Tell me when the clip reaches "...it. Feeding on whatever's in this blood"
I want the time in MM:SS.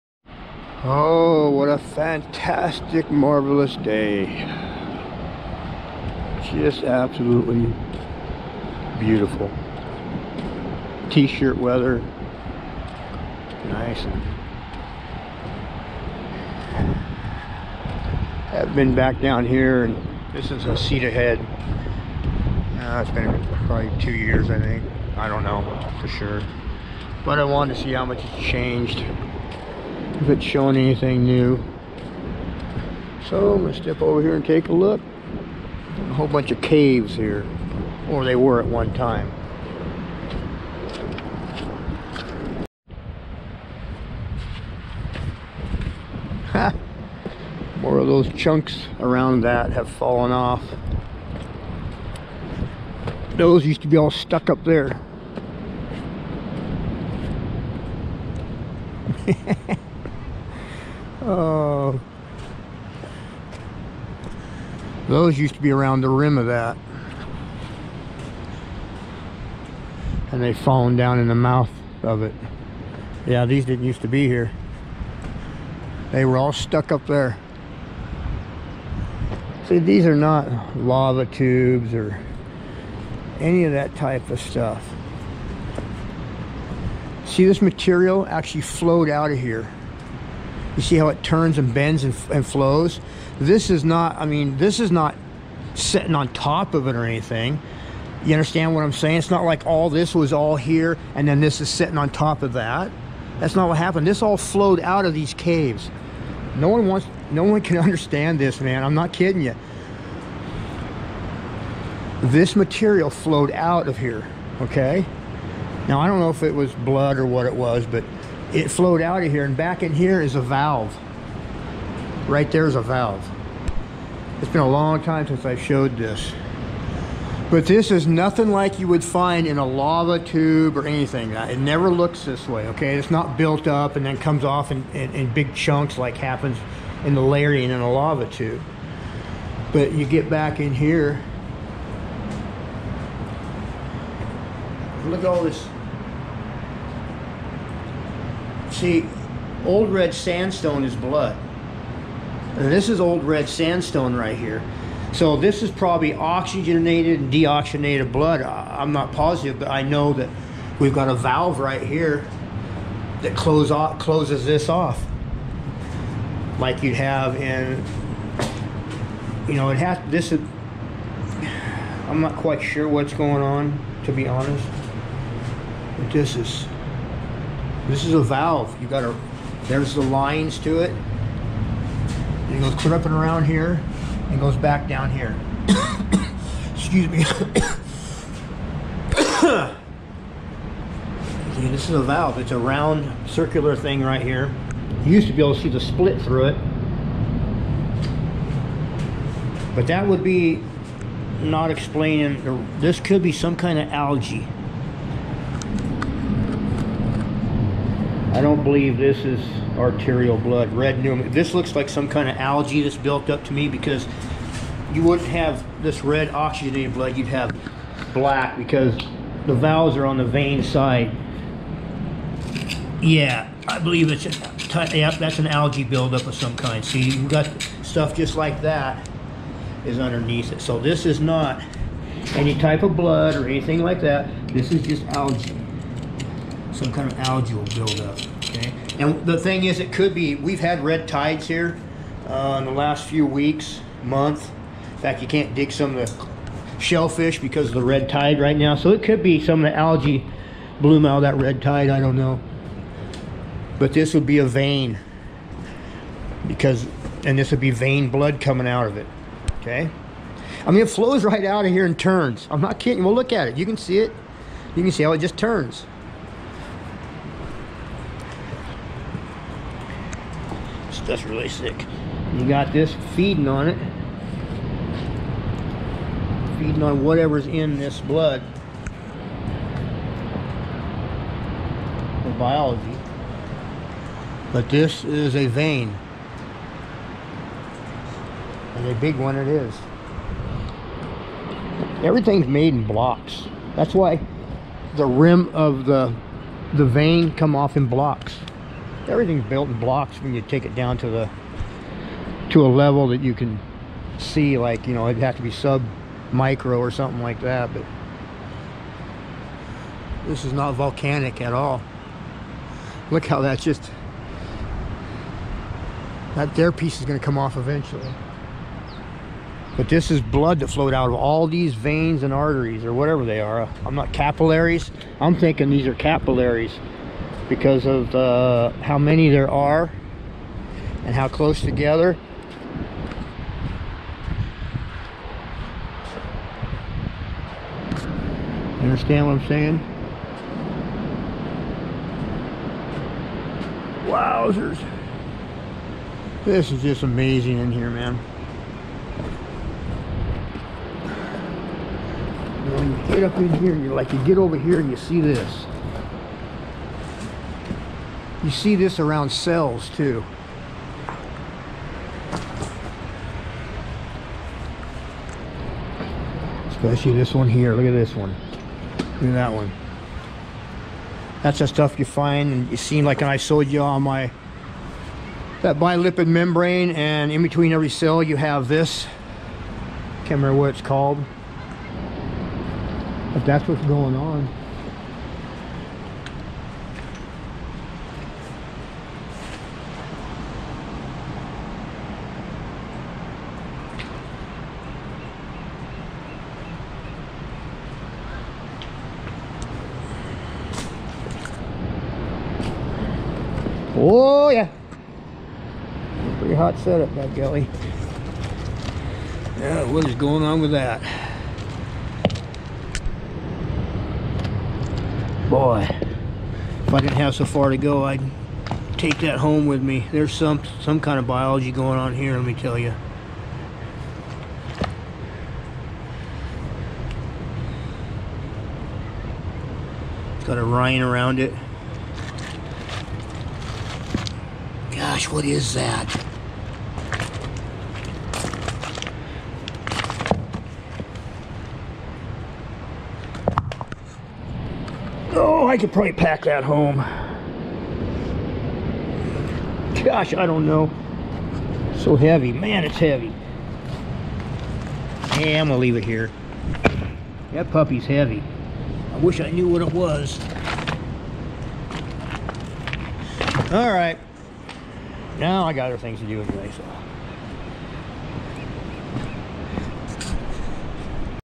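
04:33.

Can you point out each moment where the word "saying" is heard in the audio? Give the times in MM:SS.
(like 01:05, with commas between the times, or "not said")
01:38, 05:39.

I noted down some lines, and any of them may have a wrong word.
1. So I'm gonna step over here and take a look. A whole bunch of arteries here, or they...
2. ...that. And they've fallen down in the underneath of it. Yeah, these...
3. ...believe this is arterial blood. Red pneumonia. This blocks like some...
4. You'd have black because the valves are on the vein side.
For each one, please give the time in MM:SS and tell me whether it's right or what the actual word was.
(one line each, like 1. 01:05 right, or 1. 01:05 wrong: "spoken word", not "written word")
1. 00:33 wrong: "caves", not "arteries"
2. 01:06 wrong: "mouth", not "underneath"
3. 03:28 wrong: "looks", not "blocks"
4. 03:37 right.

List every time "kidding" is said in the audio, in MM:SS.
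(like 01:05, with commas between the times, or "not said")
01:49, 04:22.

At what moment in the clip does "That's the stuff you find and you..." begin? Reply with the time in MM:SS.
06:11.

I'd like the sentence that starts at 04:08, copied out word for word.
So it could be some of the algae bloom out of that red tide.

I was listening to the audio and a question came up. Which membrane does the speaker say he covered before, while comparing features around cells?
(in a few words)
Bilipid membrane.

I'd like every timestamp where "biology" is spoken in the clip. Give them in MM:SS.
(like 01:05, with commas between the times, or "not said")
04:42, 07:01.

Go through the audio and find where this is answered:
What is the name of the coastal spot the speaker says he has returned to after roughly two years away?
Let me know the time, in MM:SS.
00:20.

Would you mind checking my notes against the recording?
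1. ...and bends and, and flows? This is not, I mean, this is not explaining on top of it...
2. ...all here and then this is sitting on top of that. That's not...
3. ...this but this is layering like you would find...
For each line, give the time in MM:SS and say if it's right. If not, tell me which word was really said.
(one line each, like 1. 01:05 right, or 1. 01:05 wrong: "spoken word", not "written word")
1. 01:31 wrong: "sitting", not "explaining"
2. 01:40 right
3. 02:05 wrong: "nothing", not "layering".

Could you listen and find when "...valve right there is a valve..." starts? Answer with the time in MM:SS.
02:00.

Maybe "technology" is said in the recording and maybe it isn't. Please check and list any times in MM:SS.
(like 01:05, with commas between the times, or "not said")
not said.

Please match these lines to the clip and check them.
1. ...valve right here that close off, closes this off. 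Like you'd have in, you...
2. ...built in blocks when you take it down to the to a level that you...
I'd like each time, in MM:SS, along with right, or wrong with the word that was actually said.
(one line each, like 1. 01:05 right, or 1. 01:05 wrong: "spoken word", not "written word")
1. 02:41 right
2. 04:59 right.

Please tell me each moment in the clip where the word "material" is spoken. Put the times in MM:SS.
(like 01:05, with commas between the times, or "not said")
01:27, 01:52.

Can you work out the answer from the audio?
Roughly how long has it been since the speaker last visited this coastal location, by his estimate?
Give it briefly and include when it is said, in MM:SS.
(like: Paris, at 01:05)
2 years, at 00:24.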